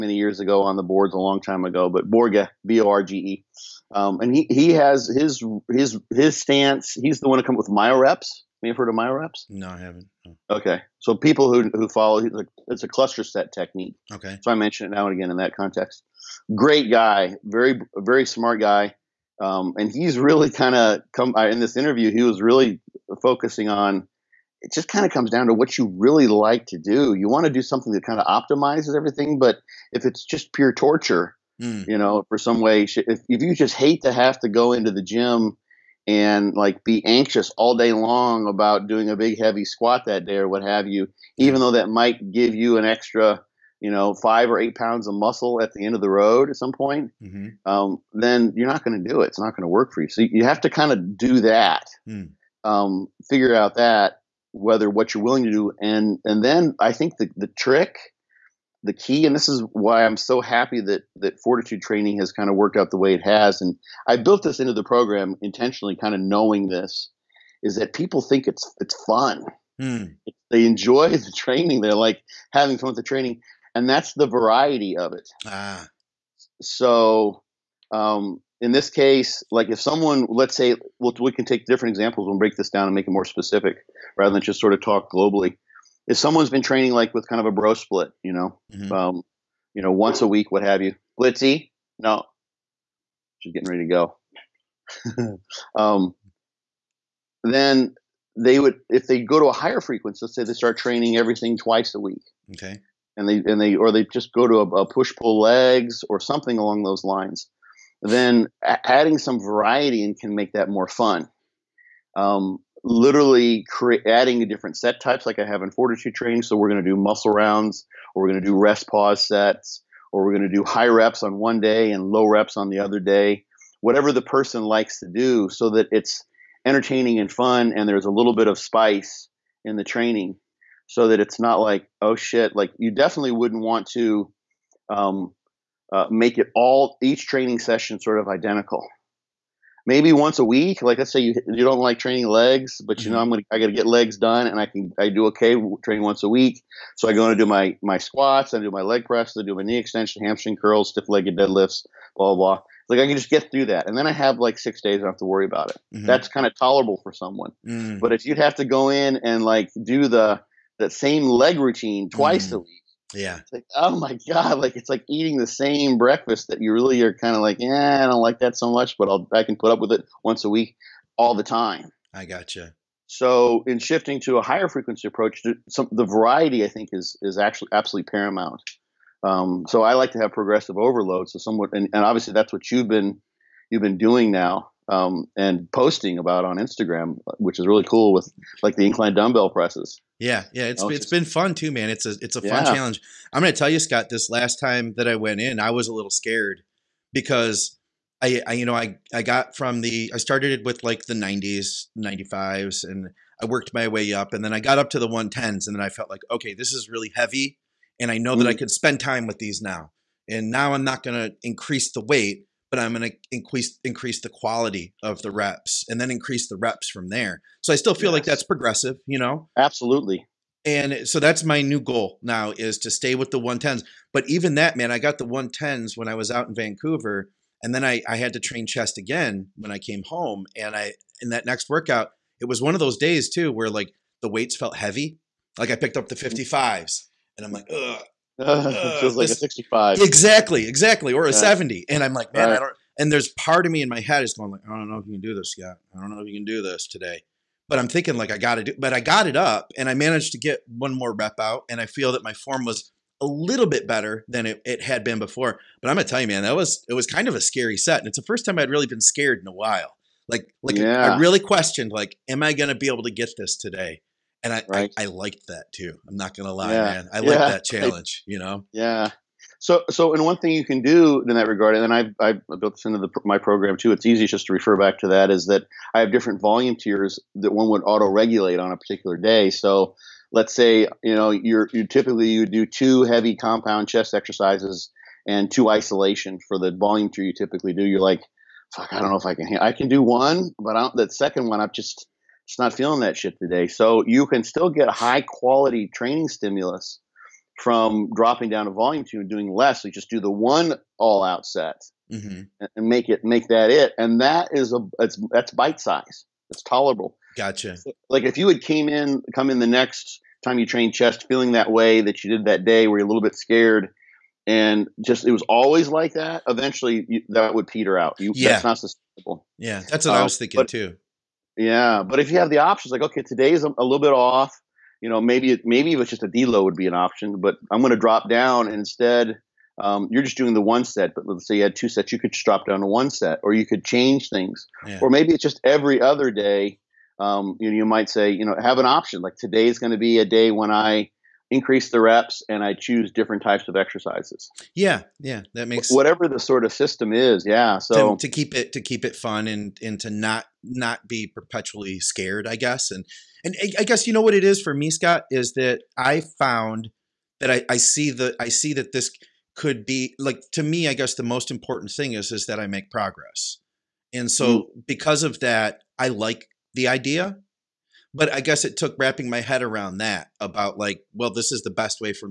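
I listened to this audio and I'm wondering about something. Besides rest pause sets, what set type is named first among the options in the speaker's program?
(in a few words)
Muscle rounds.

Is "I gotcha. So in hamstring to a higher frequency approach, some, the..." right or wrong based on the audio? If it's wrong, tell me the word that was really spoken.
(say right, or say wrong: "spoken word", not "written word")
wrong: "shifting", not "hamstring".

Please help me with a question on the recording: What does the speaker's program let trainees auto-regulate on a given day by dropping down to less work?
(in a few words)
Volume tiers.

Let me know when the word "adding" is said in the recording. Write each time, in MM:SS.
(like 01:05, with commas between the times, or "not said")
01:48, 01:54.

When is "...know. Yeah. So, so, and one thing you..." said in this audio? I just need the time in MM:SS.
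04:28.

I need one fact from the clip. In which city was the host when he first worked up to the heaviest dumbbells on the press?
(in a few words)
Vancouver.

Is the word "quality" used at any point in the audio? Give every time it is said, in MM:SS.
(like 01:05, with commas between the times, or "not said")
03:34, 04:55.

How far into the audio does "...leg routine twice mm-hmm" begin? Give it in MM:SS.
02:41.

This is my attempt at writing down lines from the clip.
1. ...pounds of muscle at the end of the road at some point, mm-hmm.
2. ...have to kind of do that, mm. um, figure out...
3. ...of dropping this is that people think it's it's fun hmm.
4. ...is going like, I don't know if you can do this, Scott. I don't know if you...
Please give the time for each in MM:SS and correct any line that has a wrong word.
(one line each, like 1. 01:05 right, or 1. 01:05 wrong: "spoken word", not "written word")
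1. 00:44 right
2. 00:50 right
3. 01:06 wrong: "knowing", not "dropping"
4. 04:04 right.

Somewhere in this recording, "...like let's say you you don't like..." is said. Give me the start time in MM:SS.
02:20.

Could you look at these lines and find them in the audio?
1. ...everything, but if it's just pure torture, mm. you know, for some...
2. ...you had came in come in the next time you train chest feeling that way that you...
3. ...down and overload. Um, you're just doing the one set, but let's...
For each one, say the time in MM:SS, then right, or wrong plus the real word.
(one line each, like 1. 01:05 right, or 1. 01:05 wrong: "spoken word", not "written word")
1. 00:28 right
2. 05:08 right
3. 05:28 wrong: "instead", not "overload".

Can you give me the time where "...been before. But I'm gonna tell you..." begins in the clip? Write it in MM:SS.
04:15.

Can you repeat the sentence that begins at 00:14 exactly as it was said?
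Okay, so I mention it now and again in that context.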